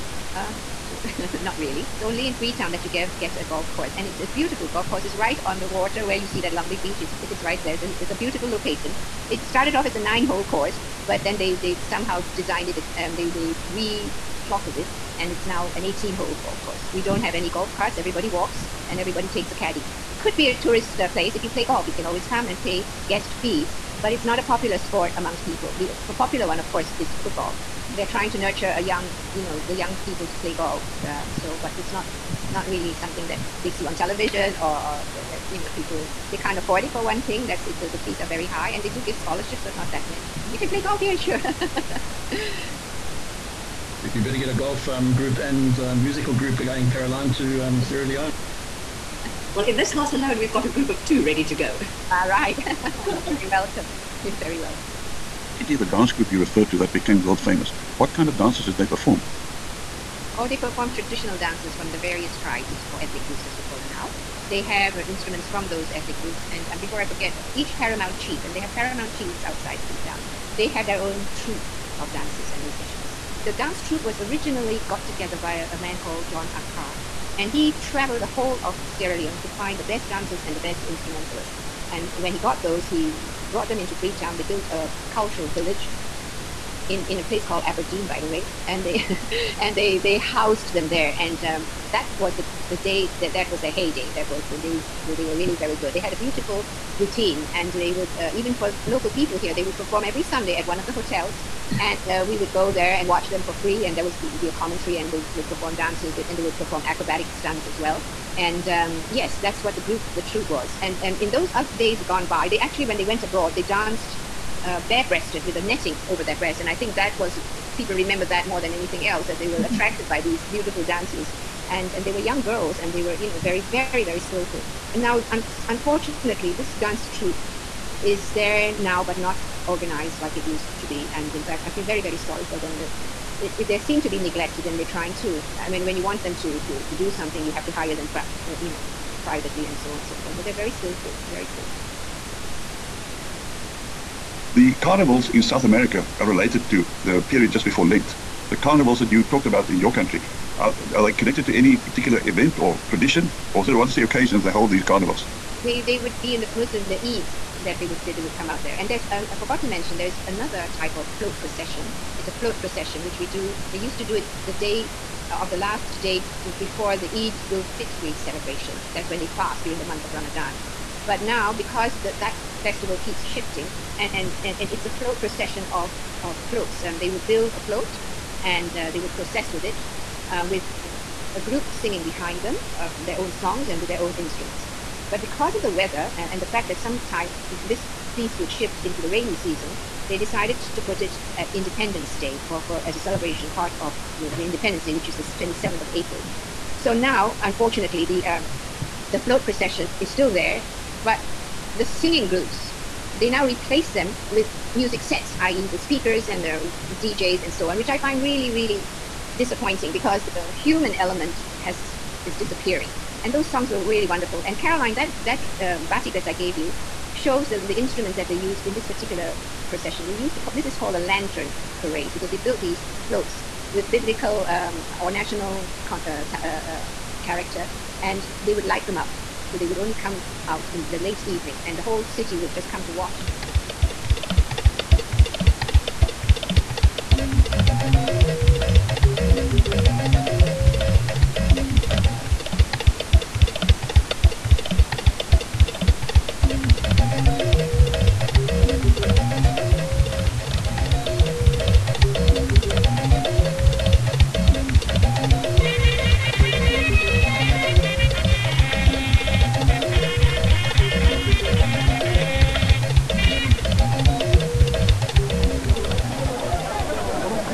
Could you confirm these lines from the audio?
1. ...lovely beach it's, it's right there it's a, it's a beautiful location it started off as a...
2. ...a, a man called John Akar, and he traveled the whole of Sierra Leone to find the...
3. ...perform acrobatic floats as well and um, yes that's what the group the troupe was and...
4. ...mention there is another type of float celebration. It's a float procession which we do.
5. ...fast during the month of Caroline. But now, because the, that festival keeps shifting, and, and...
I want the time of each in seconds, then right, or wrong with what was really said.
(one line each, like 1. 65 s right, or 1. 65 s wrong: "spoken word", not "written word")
1. 6 s right
2. 75 s right
3. 106 s wrong: "stunts", not "floats"
4. 159 s wrong: "procession", not "celebration"
5. 169 s wrong: "Ramadan", not "Caroline".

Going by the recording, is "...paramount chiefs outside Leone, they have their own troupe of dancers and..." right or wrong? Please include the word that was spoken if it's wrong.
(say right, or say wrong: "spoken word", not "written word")
wrong: "Freetown", not "Leone".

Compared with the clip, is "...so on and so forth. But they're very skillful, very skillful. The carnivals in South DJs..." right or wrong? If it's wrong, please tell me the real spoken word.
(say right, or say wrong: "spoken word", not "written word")
wrong: "America", not "DJs".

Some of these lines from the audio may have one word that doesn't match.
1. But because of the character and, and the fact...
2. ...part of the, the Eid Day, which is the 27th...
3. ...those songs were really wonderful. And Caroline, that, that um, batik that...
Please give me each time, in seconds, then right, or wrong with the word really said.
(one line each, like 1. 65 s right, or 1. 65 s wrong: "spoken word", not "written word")
1. 185 s wrong: "weather", not "character"
2. 193 s wrong: "Independence", not "Eid"
3. 213 s right.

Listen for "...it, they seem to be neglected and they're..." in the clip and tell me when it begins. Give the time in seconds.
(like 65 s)
133 s.